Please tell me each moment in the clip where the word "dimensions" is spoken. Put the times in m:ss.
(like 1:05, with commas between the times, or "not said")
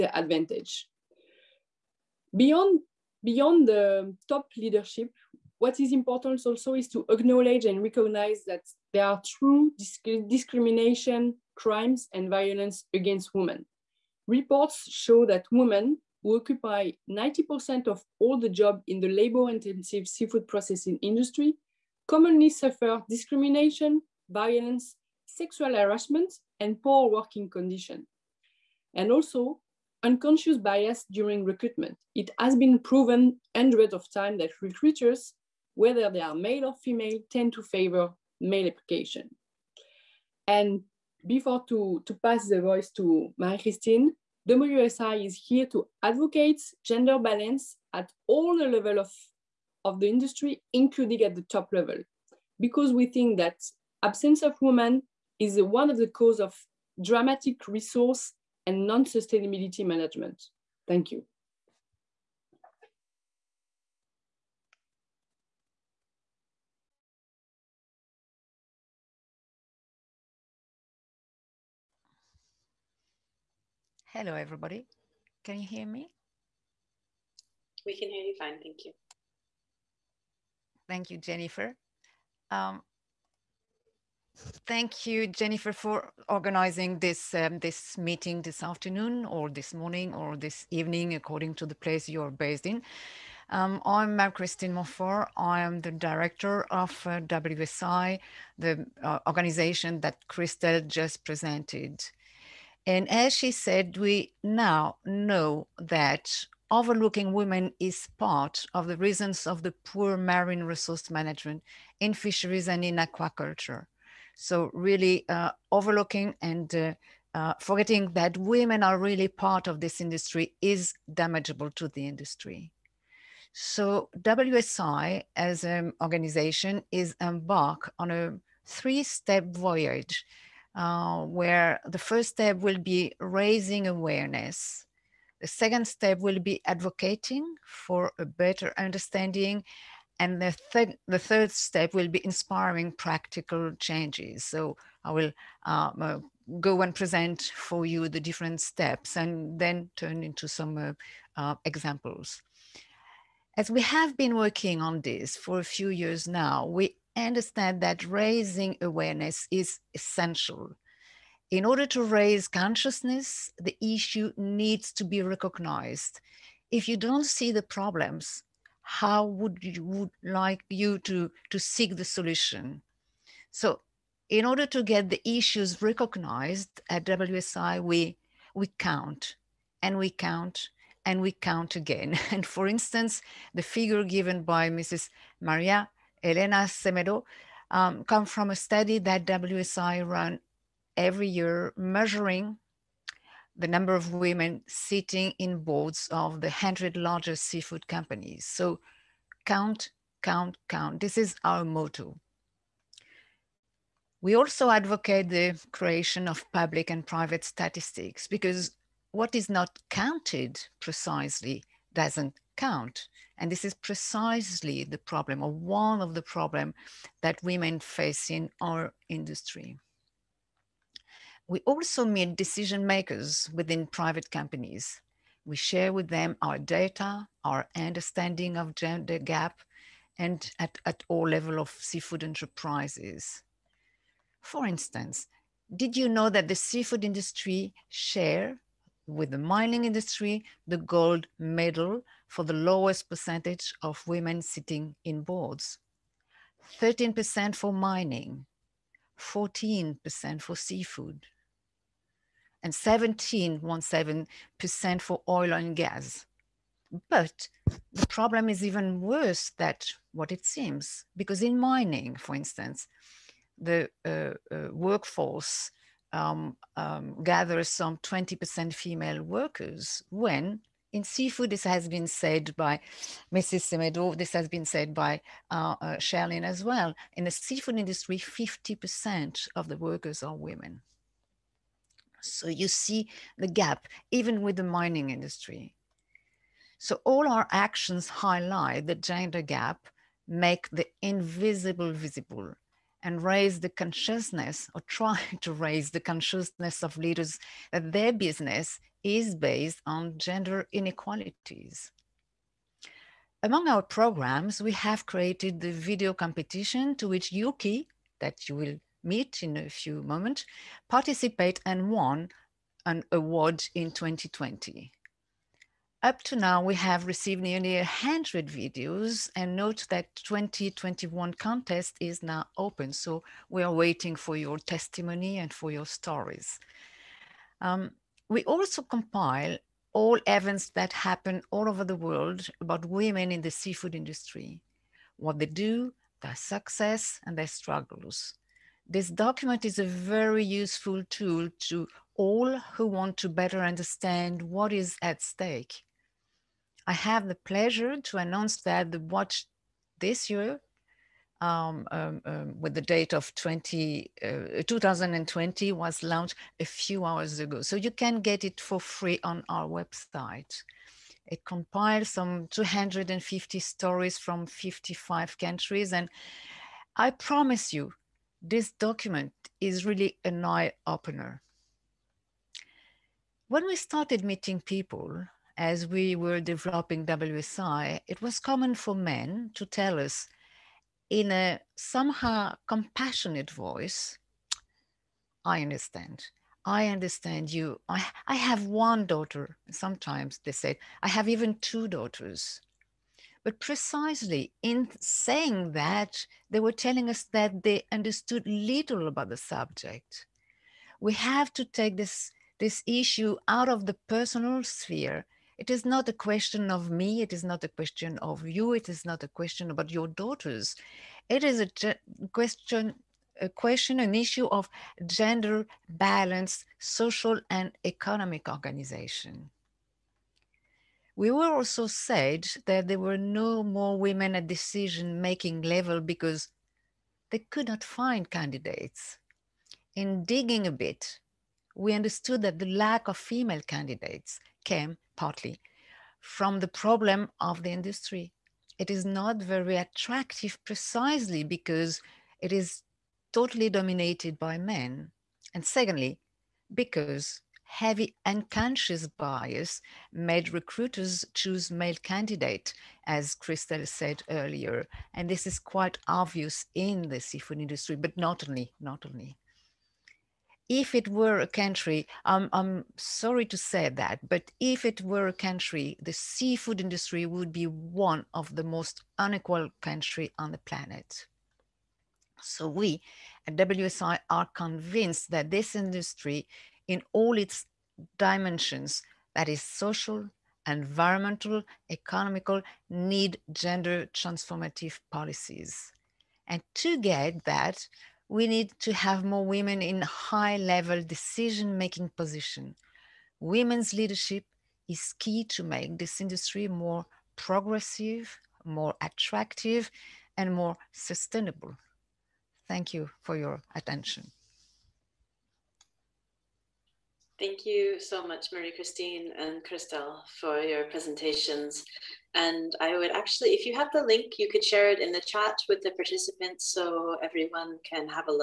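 7:58.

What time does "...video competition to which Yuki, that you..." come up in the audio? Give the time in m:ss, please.
5:05.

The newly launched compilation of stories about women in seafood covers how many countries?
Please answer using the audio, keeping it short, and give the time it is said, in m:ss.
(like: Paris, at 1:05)
55, at 6:04.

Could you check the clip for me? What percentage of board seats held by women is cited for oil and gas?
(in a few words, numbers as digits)
17.17%.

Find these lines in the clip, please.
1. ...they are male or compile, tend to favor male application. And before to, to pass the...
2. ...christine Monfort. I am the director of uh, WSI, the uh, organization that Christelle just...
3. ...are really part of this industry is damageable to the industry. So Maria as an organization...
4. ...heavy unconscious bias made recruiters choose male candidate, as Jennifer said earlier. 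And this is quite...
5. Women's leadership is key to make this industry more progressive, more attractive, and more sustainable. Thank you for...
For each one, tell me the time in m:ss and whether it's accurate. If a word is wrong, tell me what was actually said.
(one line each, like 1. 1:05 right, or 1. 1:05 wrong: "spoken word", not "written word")
1. 0:36 wrong: "female", not "compile"
2. 1:34 right
3. 1:58 wrong: "WSI", not "Maria"
4. 7:27 wrong: "Christelle", not "Jennifer"
5. 8:13 right.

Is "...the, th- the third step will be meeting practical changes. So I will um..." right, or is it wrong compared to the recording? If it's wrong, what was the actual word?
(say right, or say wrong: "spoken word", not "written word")
wrong: "inspiring", not "meeting".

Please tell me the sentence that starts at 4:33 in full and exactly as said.
Semedo, this has been said by uh, uh Shirlene as well.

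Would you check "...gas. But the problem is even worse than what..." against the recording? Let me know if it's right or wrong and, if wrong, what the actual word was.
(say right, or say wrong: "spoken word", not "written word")
right.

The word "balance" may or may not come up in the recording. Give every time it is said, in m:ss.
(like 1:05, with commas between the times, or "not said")
0:47, 6:55.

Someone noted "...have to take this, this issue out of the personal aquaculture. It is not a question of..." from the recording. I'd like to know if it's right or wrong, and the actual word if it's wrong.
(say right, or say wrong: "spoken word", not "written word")
wrong: "sphere", not "aquaculture".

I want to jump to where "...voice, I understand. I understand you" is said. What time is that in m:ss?
6:23.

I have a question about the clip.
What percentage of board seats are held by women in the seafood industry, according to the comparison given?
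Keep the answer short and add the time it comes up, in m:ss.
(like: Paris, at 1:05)
14%, at 4:09.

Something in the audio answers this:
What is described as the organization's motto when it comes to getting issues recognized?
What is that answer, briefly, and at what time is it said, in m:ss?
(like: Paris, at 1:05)
Count, count, count, at 3:19.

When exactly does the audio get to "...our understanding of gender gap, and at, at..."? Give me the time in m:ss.
3:47.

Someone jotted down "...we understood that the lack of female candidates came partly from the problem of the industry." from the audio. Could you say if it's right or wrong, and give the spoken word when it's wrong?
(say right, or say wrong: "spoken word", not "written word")
right.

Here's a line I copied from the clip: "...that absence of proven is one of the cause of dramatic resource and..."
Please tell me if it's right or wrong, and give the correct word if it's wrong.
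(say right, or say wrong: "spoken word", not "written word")
wrong: "women", not "proven".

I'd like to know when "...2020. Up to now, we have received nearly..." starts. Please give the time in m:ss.
5:13.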